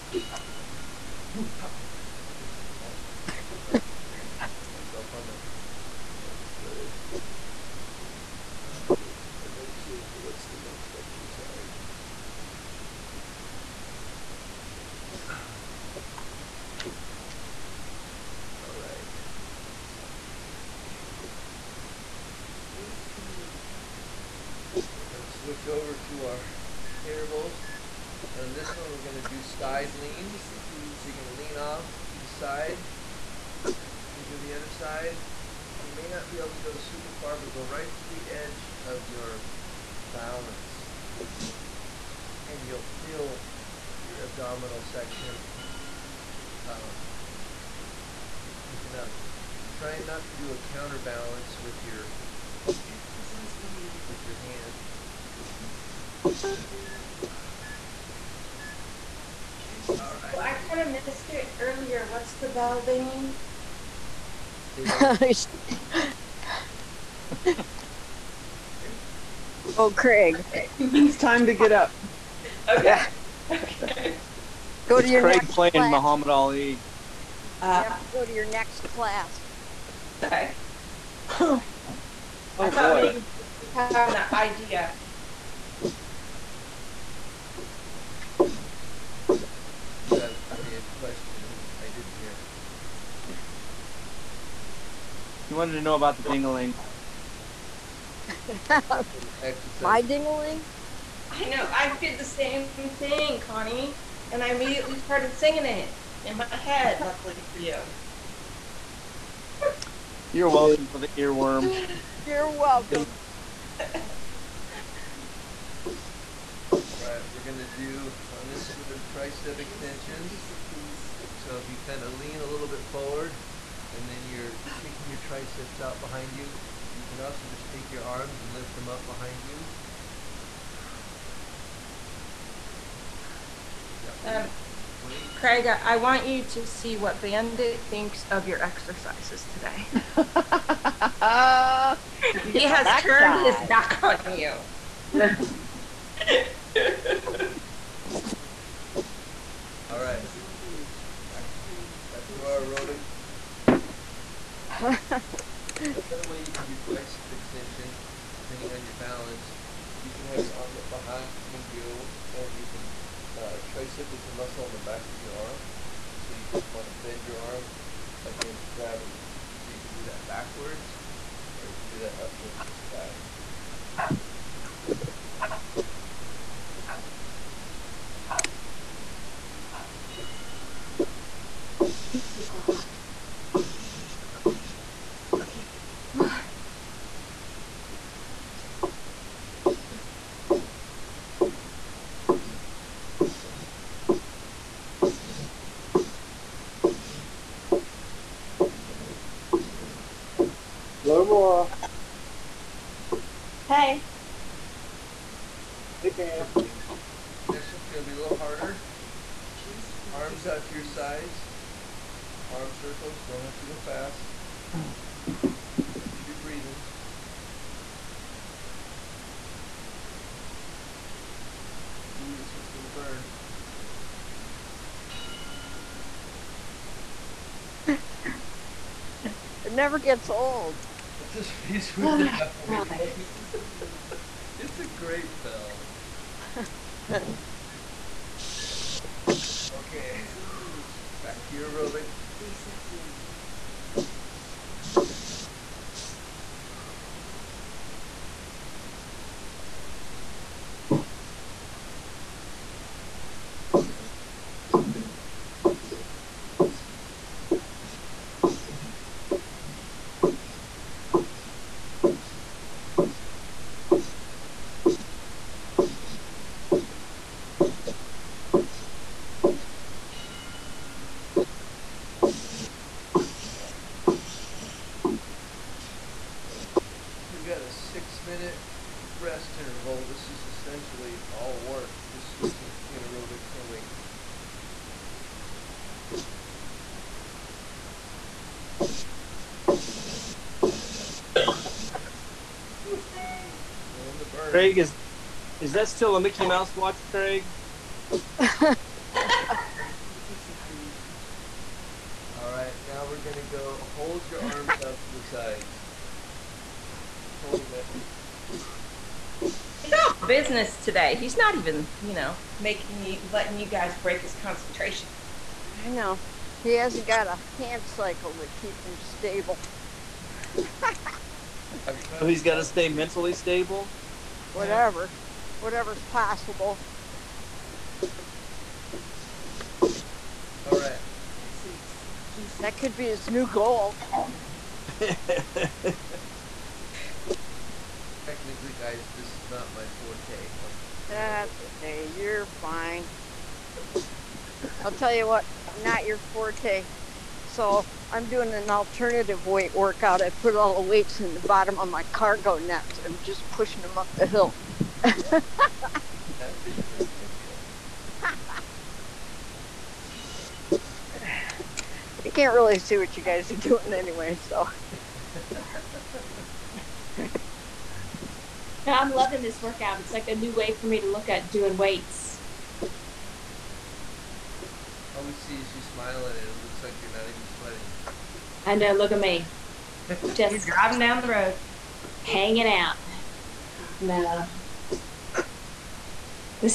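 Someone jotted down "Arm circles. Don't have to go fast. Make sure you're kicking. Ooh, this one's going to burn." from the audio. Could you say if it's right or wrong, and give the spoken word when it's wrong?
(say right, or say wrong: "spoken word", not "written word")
wrong: "breathing", not "kicking".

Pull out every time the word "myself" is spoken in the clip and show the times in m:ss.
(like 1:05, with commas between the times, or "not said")
0:04.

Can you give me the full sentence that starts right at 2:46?
And so you just want to bend your arm against gravity.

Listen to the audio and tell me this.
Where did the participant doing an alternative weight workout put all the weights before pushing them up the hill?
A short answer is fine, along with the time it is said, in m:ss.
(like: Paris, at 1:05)
cargo net, at 5:52.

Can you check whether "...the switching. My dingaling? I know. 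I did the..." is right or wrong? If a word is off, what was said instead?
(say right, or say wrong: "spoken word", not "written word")
wrong: "dingaling", not "switching".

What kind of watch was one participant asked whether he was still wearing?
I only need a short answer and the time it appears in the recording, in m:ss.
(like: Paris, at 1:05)
Mickey Mouse watch, at 4:56.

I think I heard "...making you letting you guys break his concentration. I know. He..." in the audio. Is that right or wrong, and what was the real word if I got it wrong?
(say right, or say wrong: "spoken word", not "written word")
right.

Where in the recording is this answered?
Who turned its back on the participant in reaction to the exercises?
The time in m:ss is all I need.
2:17.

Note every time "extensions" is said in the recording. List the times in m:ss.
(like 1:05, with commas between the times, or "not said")
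1:59, 2:37.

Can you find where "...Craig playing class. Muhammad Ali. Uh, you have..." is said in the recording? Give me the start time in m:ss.
1:15.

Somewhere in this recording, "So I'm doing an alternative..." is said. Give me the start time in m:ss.
5:47.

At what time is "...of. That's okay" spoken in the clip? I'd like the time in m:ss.
5:40.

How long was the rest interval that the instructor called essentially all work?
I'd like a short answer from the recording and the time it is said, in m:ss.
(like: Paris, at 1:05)
6 minutes, at 4:37.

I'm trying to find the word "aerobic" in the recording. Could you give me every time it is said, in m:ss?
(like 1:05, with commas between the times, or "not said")
2:32, 4:01, 4:43.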